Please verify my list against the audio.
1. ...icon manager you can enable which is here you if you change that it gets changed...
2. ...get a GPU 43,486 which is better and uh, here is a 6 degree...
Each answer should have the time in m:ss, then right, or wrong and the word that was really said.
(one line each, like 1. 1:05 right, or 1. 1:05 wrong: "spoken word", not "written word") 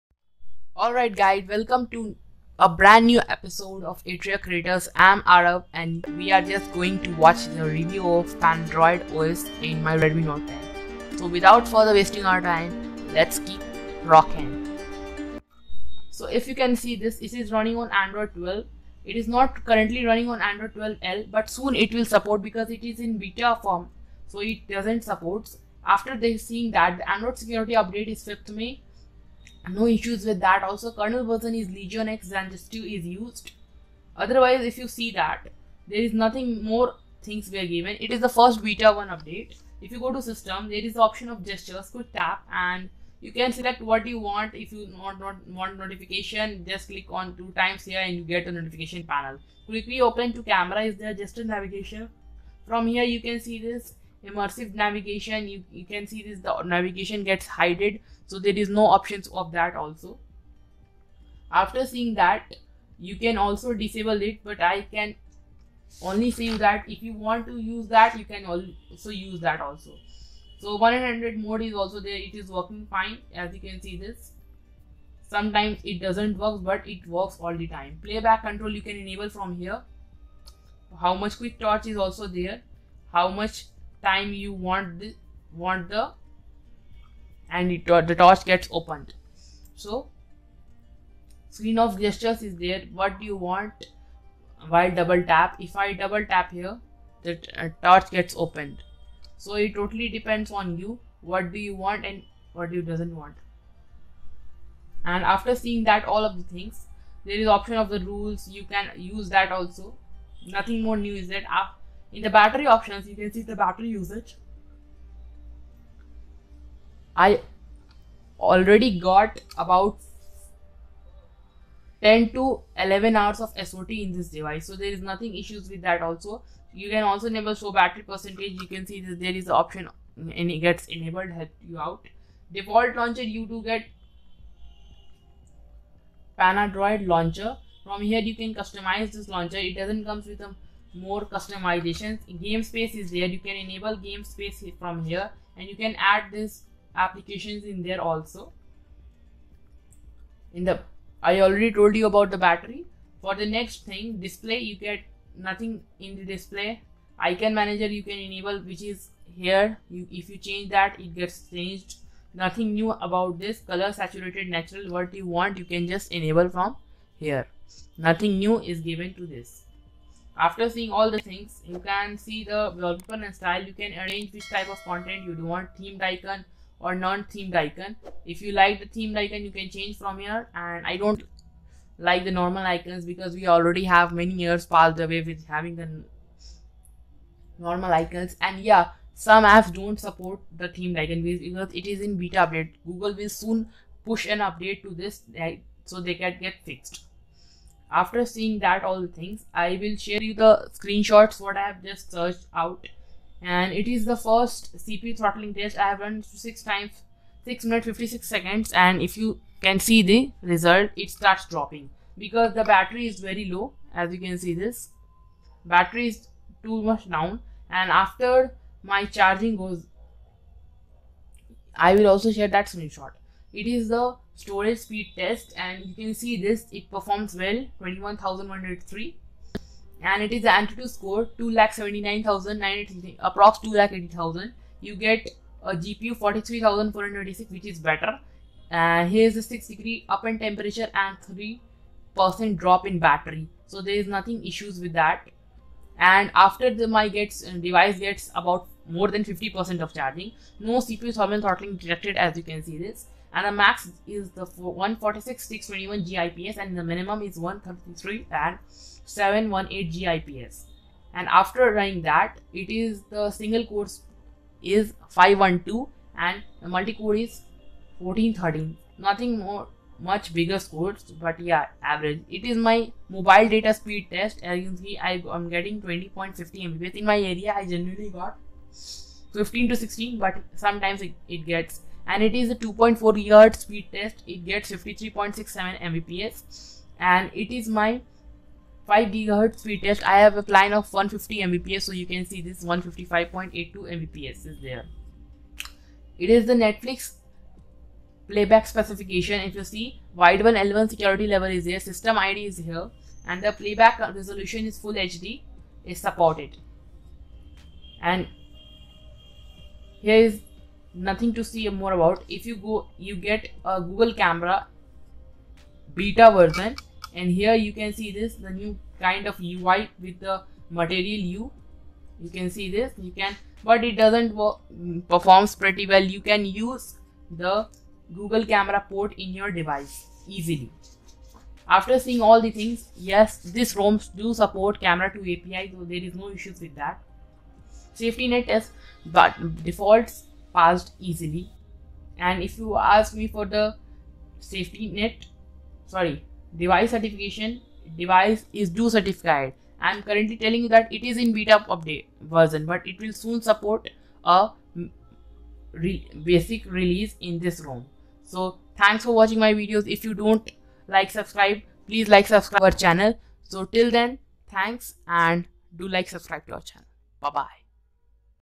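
1. 2:37 right
2. 3:55 right.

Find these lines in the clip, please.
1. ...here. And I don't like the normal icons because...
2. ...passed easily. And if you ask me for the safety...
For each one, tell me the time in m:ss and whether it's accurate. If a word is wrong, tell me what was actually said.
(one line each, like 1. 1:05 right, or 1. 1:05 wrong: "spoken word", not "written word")
1. 3:00 right
2. 5:40 right.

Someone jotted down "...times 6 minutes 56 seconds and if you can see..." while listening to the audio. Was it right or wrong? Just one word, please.
right.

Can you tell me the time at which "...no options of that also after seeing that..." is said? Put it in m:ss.
0:58.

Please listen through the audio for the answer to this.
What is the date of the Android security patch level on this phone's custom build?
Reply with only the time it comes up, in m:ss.
0:28.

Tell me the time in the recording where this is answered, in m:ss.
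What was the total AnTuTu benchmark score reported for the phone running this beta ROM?
3:51.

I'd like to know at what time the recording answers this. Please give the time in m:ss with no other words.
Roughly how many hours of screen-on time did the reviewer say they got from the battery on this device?
2:02.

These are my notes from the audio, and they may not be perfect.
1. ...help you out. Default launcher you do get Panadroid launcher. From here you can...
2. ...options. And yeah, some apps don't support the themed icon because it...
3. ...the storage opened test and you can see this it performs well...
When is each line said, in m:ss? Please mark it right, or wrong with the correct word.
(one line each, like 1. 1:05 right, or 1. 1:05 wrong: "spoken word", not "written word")
1. 2:11 right
2. 3:07 wrong: "icons", not "options"
3. 3:43 wrong: "speed", not "opened".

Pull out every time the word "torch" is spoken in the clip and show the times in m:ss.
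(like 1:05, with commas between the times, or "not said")
1:21, 1:28, 1:37.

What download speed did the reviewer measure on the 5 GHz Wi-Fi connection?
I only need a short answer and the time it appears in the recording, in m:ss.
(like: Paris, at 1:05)
155.82 Mbps, at 4:52.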